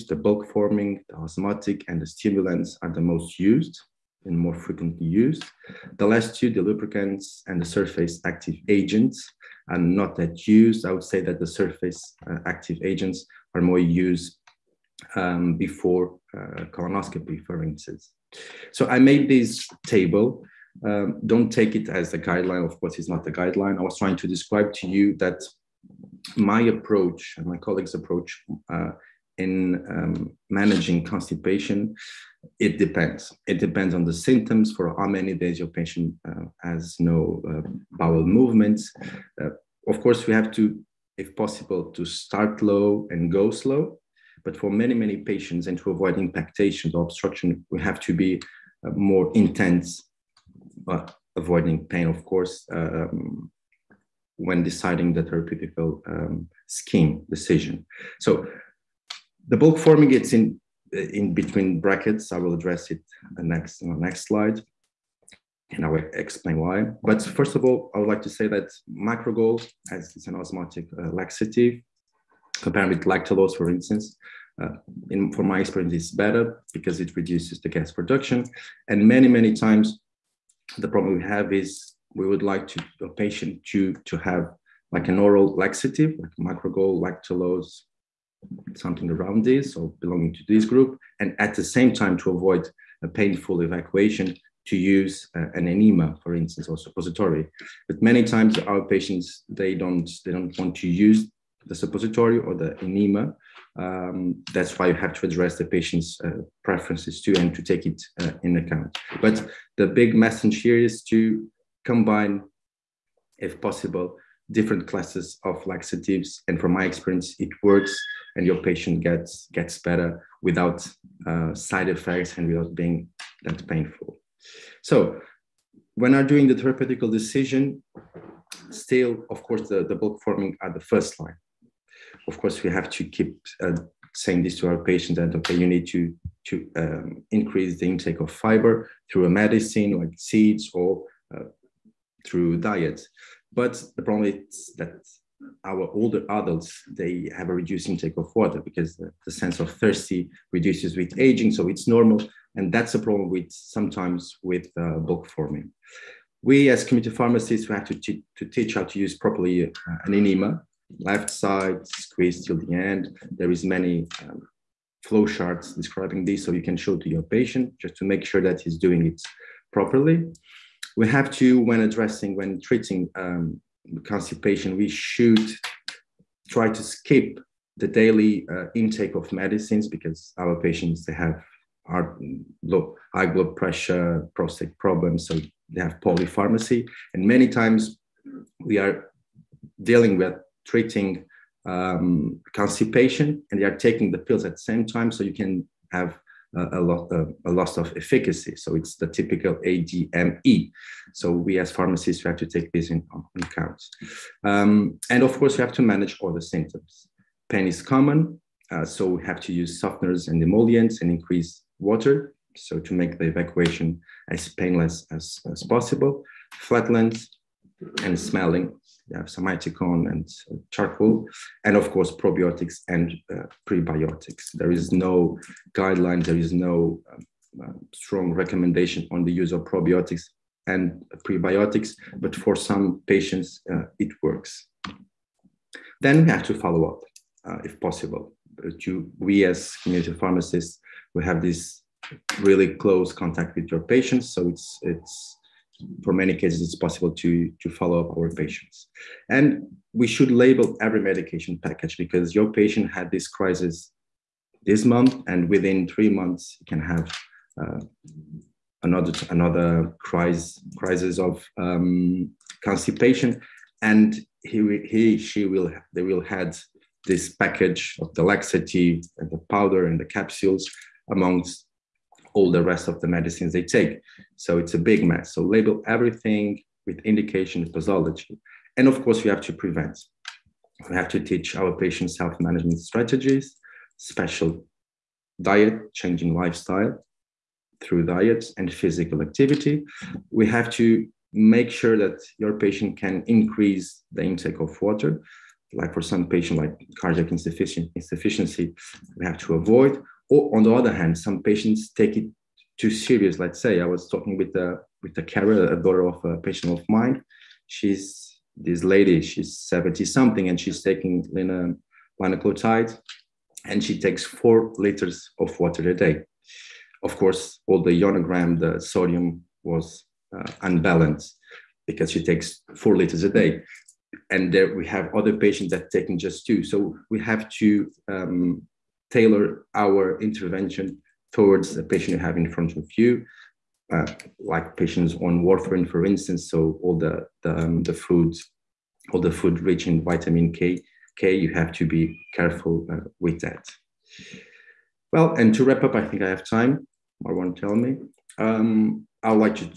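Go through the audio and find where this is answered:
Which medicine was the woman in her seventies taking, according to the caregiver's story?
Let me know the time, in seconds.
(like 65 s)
312 s.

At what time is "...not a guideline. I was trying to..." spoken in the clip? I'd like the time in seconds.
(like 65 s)
23 s.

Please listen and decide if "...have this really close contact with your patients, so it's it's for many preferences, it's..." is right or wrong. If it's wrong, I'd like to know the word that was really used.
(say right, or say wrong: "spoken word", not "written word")
wrong: "cases", not "preferences".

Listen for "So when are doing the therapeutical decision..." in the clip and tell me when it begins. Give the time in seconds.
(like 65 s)
124 s.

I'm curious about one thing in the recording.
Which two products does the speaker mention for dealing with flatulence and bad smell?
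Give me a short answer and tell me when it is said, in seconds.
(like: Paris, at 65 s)
Simethicone and charcoal, at 219 s.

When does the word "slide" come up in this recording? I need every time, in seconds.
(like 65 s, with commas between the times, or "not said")
64 s.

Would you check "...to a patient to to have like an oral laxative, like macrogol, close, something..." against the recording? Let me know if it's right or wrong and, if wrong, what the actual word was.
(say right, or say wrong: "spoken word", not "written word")
wrong: "lactulose", not "close".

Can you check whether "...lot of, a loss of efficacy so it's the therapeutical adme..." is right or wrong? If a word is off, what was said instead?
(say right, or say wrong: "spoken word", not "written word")
wrong: "typical", not "therapeutical".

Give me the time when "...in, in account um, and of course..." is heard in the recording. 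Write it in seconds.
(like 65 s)
202 s.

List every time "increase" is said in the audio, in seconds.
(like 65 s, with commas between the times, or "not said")
137 s, 211 s, 293 s.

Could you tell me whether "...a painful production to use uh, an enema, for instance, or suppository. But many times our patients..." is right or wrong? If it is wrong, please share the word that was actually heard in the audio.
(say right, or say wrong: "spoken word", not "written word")
wrong: "evacuation", not "production".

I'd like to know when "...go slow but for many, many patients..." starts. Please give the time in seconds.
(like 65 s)
43 s.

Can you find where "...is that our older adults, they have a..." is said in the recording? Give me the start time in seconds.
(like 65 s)
144 s.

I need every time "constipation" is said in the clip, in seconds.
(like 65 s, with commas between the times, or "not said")
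31 s, 174 s, 192 s, 262 s.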